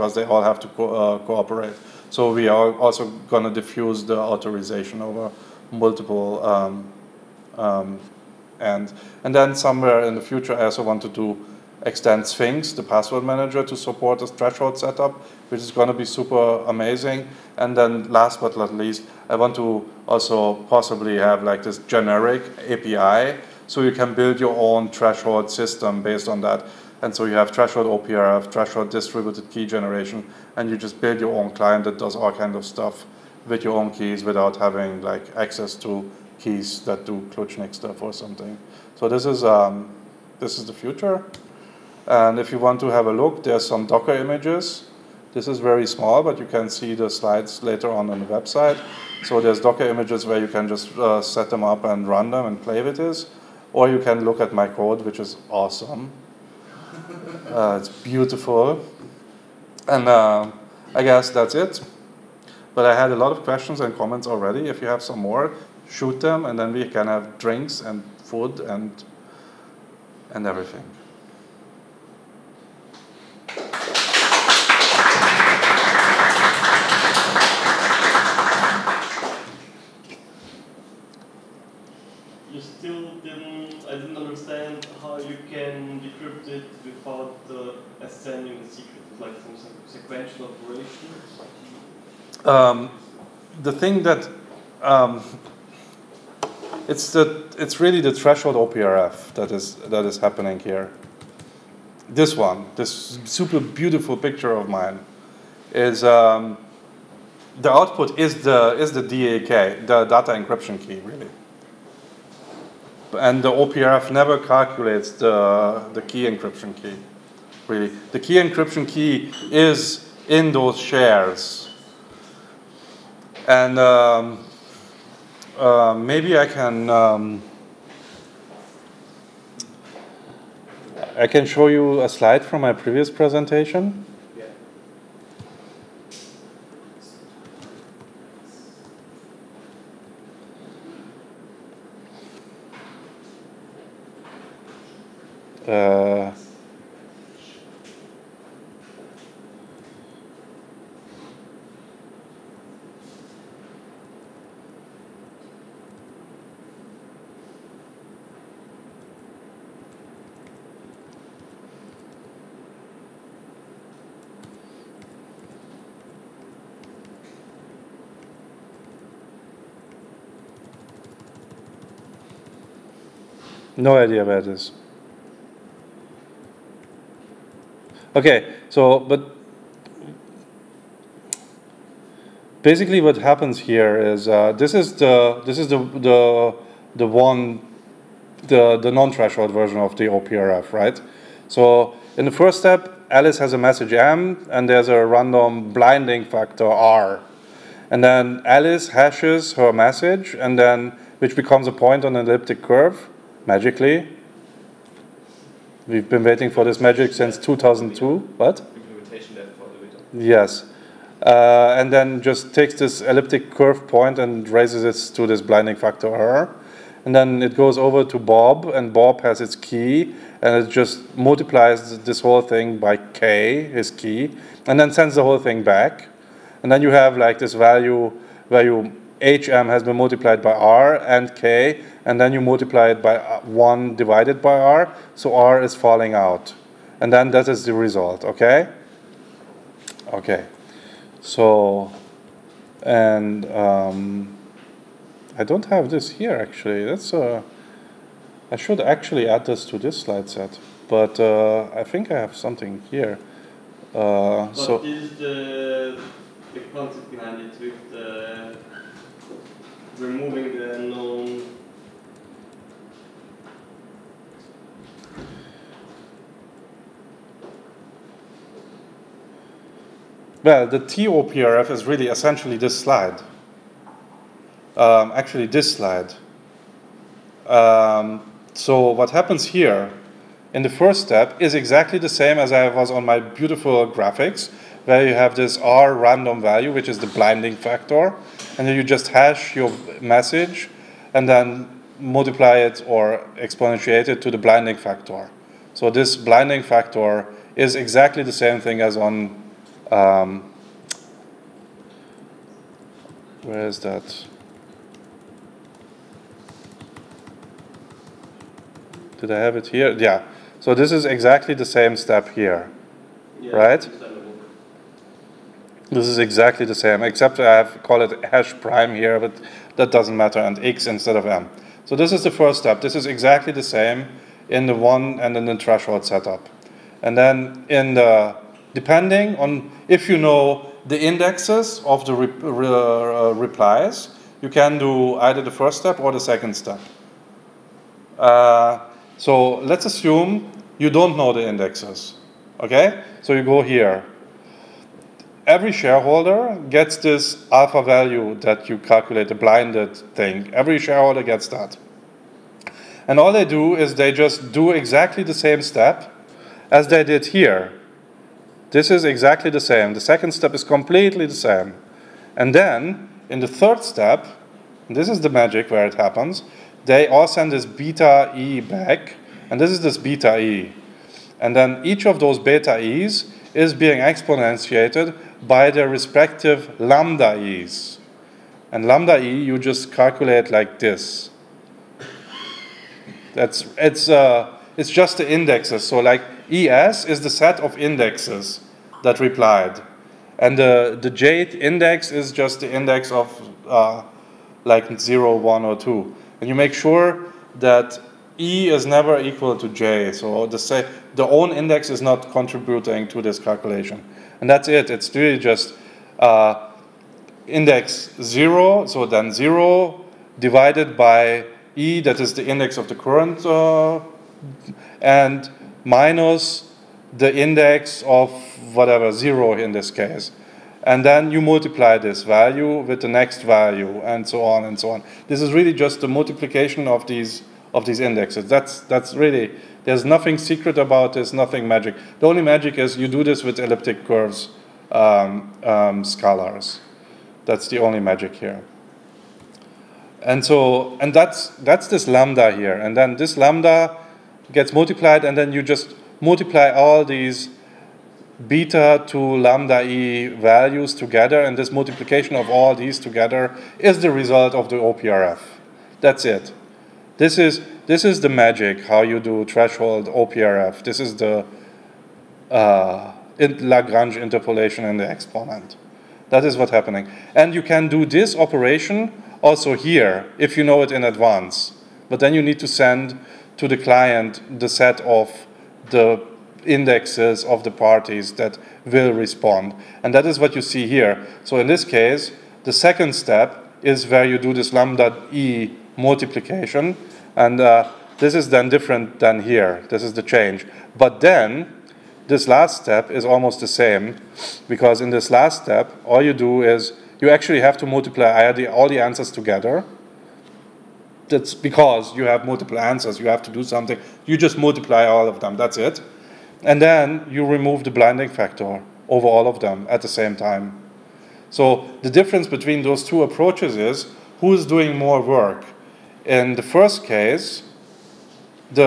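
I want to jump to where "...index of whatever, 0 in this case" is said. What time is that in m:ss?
6:57.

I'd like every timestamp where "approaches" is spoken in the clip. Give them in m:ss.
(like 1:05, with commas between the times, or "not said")
8:33.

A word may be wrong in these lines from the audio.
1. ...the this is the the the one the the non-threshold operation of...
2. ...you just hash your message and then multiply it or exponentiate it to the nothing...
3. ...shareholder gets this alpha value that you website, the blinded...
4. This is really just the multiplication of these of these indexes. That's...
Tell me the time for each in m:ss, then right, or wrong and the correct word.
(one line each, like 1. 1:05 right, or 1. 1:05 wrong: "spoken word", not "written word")
1. 3:04 wrong: "version", not "operation"
2. 4:48 wrong: "blinding", not "nothing"
3. 5:45 wrong: "calculate", not "website"
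4. 7:05 right.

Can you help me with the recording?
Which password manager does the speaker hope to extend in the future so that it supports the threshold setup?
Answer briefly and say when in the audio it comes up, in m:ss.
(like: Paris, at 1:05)
Sphinx, at 0:12.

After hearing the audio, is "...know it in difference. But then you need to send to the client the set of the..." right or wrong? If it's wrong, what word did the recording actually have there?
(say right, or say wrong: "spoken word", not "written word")
wrong: "advance", not "difference".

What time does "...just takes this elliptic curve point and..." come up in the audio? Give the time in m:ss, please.
3:32.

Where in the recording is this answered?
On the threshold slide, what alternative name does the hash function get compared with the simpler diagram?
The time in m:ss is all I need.
5:18.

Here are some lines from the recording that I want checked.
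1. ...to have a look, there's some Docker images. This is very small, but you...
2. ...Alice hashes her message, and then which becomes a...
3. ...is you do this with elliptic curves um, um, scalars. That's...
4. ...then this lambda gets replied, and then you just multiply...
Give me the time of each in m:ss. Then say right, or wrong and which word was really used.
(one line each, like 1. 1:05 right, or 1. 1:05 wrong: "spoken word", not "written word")
1. 0:42 right
2. 3:18 right
3. 7:12 right
4. 7:22 wrong: "multiplied", not "replied".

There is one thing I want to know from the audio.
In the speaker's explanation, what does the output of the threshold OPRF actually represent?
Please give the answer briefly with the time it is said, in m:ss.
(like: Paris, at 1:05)
data encryption key, at 1:49.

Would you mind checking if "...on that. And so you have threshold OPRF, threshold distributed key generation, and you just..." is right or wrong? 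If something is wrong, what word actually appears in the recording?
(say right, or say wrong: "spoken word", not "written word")
right.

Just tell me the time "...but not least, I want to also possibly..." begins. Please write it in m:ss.
0:18.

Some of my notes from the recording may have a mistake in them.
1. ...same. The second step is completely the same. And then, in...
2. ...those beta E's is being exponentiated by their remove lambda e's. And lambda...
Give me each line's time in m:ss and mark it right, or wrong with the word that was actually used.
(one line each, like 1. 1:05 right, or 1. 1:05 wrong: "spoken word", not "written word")
1. 5:59 right
2. 6:12 wrong: "respective", not "remove".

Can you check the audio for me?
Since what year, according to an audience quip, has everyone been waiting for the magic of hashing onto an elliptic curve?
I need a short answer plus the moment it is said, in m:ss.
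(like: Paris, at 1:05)
2002, at 3:27.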